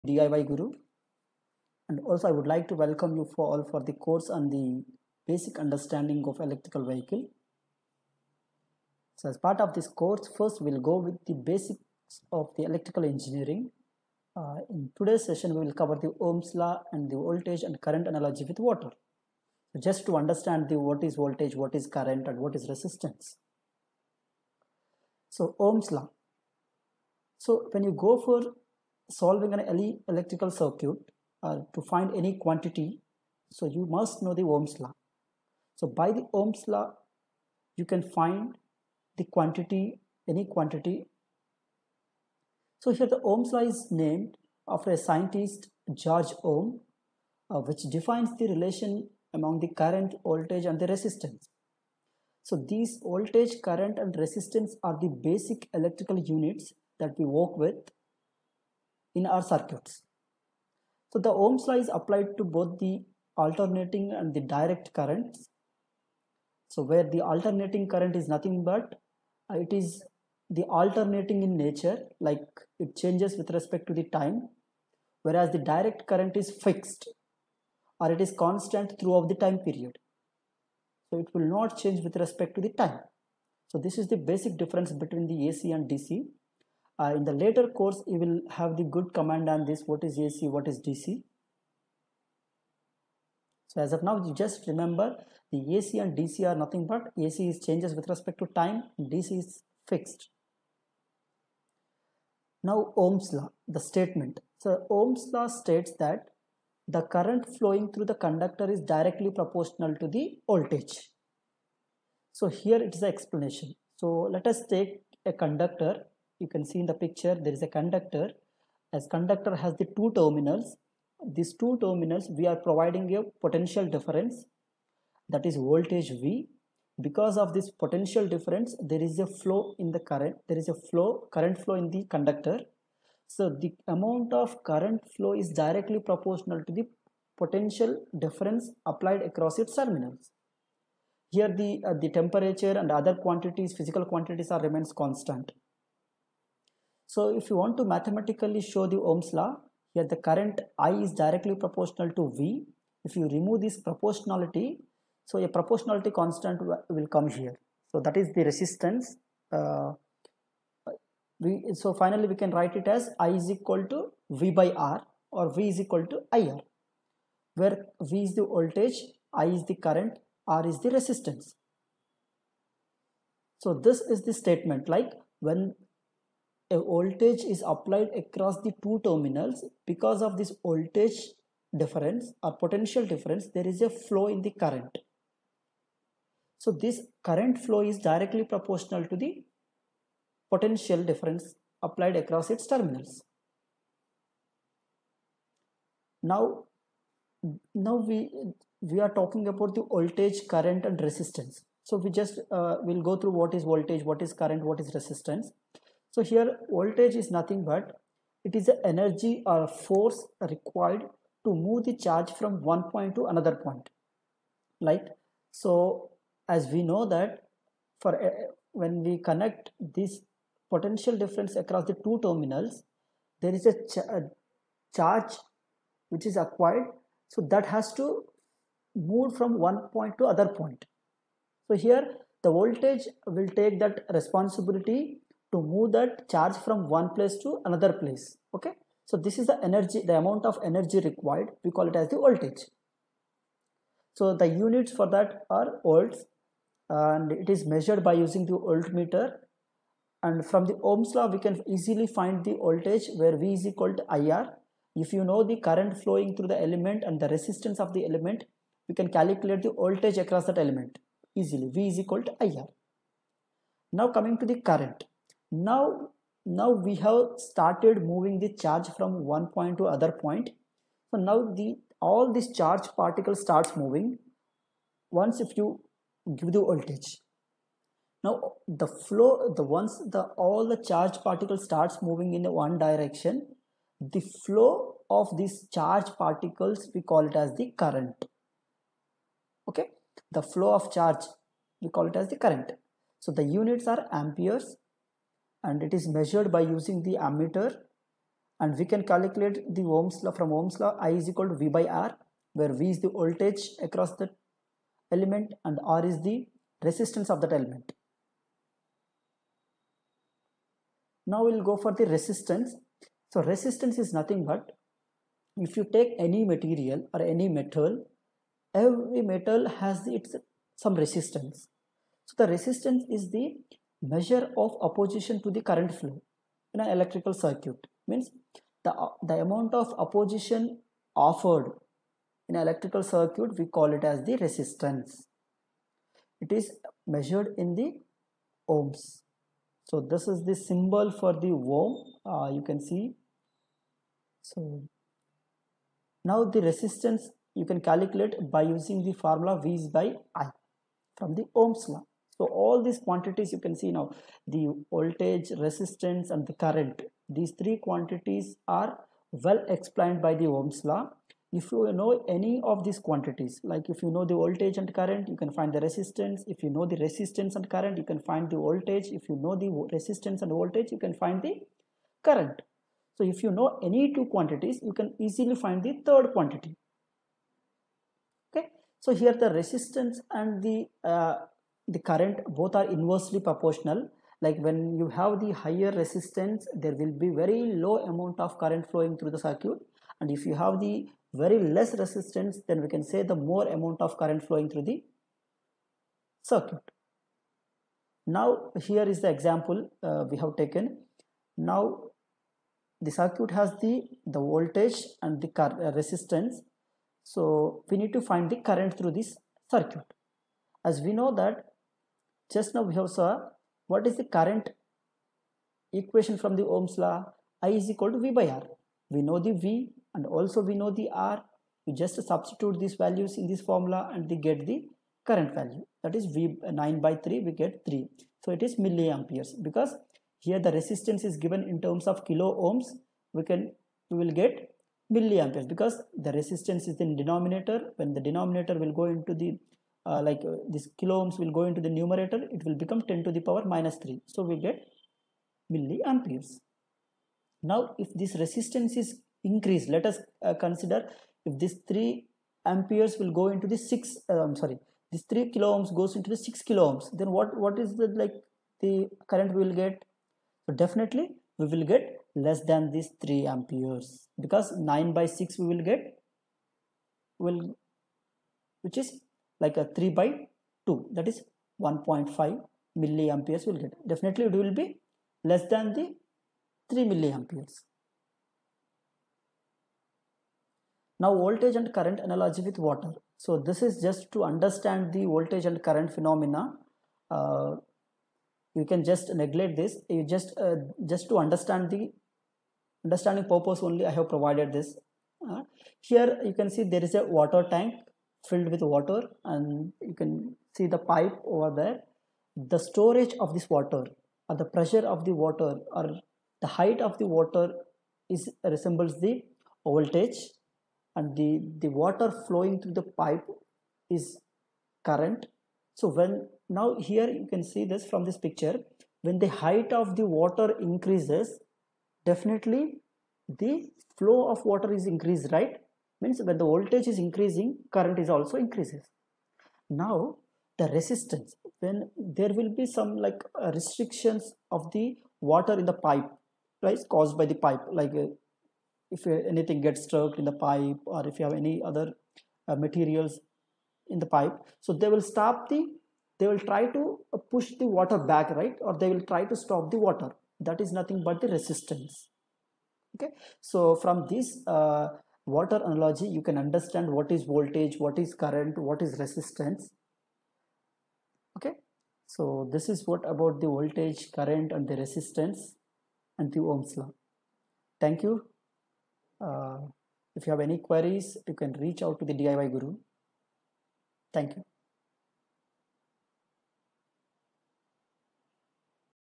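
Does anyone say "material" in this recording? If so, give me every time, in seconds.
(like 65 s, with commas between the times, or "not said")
316 s, 542 s.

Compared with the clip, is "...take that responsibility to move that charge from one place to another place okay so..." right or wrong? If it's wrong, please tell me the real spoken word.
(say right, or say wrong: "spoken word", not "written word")
right.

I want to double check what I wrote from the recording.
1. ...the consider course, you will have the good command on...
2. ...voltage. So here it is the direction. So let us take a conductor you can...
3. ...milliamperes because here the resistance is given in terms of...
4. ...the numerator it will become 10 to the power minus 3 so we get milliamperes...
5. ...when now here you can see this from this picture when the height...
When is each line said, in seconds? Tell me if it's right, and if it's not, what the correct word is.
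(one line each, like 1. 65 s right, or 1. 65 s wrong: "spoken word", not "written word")
1. 87 s wrong: "later", not "consider"
2. 110 s wrong: "explanation", not "direction"
3. 428 s right
4. 441 s right
5. 516 s right.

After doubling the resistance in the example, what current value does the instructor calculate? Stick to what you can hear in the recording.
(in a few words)
1.5 milliamperes.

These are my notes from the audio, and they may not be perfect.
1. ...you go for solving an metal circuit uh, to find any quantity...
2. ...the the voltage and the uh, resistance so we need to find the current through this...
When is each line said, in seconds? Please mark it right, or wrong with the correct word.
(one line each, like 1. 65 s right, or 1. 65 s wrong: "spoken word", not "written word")
1. 27 s wrong: "electrical", not "metal"
2. 403 s right.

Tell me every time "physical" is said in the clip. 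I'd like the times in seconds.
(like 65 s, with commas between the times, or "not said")
143 s.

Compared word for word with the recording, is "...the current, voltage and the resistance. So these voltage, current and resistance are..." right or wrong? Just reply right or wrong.
right.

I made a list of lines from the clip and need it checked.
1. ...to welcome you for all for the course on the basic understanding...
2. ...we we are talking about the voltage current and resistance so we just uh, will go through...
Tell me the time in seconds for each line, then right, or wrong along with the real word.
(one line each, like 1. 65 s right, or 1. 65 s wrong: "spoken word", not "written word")
1. 2 s right
2. 198 s right.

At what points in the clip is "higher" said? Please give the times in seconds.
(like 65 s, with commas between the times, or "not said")
385 s.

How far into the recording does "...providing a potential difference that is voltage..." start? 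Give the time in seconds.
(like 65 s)
122 s.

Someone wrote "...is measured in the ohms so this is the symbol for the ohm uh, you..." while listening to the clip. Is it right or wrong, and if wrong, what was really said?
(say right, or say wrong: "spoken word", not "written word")
right.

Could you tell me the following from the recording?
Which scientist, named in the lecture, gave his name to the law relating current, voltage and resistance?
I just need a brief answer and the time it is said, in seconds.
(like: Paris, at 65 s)
George Ohm, at 45 s.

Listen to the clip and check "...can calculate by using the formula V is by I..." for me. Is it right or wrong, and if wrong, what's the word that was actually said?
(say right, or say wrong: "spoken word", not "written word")
right.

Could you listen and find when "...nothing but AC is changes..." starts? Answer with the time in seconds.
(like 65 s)
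96 s.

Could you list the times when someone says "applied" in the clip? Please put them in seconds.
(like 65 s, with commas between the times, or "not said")
61 s, 138 s, 177 s, 191 s.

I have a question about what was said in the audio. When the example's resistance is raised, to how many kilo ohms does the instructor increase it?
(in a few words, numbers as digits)
6.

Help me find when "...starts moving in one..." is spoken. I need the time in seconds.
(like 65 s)
281 s.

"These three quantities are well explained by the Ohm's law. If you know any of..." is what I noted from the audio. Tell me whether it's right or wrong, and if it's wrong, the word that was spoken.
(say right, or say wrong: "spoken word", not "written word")
right.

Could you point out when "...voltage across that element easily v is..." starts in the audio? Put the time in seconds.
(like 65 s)
259 s.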